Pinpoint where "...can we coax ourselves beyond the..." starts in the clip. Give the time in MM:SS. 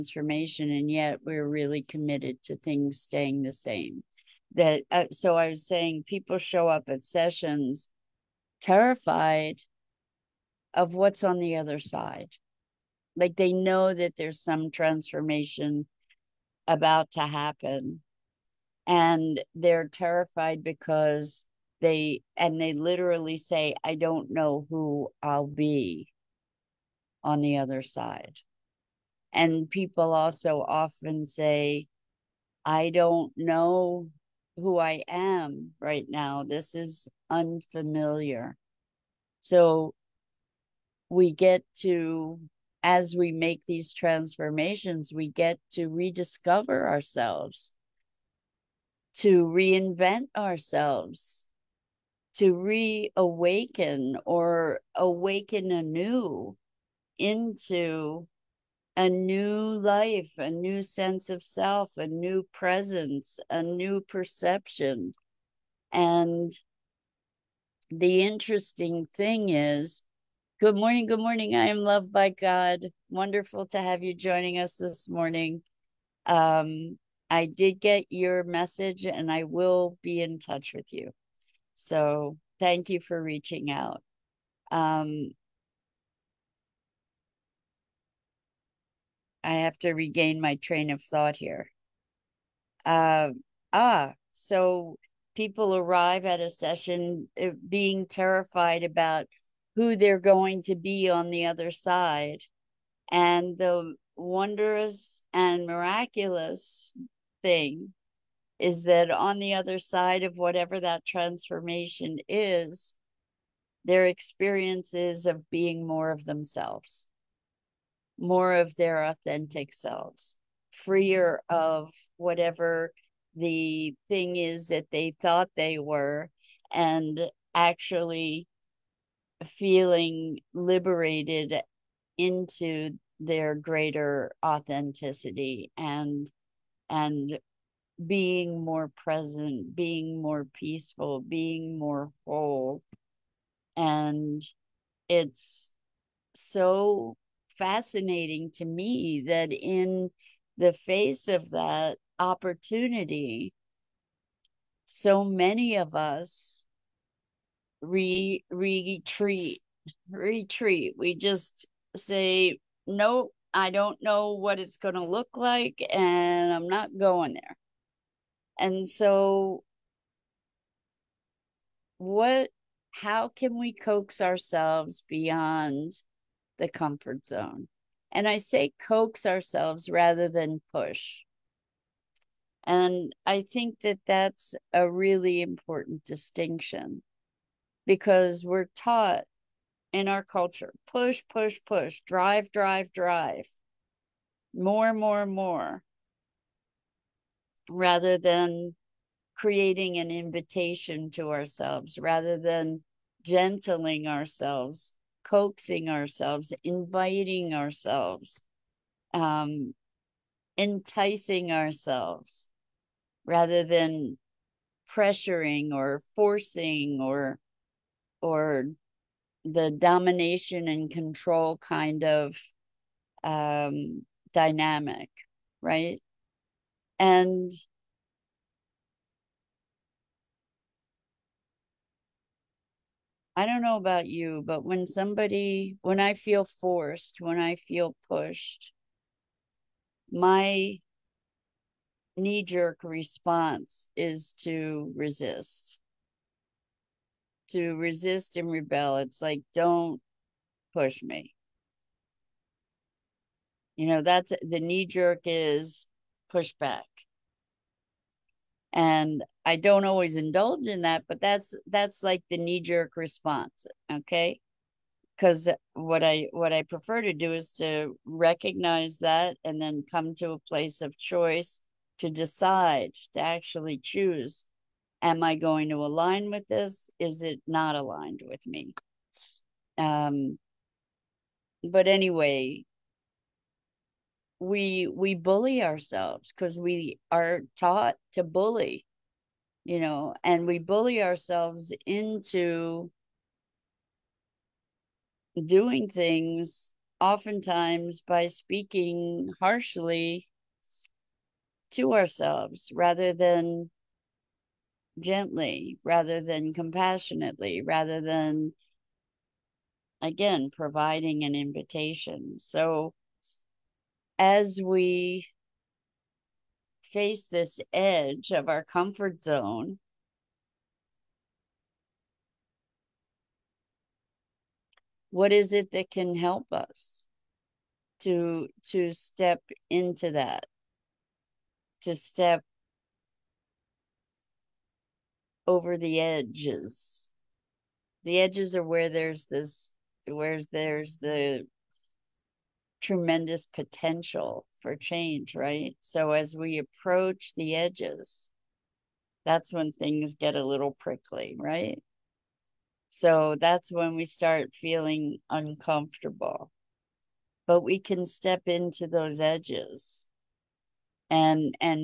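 02:53.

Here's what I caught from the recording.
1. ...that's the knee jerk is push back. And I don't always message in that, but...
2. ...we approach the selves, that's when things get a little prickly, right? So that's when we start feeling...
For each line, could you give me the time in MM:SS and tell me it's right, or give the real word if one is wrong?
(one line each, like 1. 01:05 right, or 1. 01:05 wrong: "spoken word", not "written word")
1. 04:14 wrong: "indulge", not "message"
2. 05:46 wrong: "edges", not "selves".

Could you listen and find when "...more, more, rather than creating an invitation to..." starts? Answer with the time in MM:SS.
03:14.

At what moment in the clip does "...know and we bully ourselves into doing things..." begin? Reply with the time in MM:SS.
04:49.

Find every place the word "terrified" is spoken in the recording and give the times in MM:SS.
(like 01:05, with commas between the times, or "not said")
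00:08, 00:19, 01:38.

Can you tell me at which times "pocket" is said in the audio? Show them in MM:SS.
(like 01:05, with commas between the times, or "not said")
not said.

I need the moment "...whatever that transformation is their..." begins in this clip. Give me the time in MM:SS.
01:50.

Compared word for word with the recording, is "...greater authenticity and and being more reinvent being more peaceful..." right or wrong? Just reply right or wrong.
wrong.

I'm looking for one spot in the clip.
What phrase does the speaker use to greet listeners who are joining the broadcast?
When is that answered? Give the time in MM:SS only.
01:11.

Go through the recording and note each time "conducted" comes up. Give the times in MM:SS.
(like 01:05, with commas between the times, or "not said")
not said.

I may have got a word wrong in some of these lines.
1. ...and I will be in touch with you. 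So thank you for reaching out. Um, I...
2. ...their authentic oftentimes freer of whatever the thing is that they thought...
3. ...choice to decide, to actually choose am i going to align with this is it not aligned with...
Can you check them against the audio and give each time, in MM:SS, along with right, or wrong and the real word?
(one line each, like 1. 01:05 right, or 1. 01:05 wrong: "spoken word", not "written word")
1. 01:19 right
2. 01:58 wrong: "selves", not "oftentimes"
3. 04:30 right.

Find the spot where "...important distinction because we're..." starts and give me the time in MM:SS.
03:05.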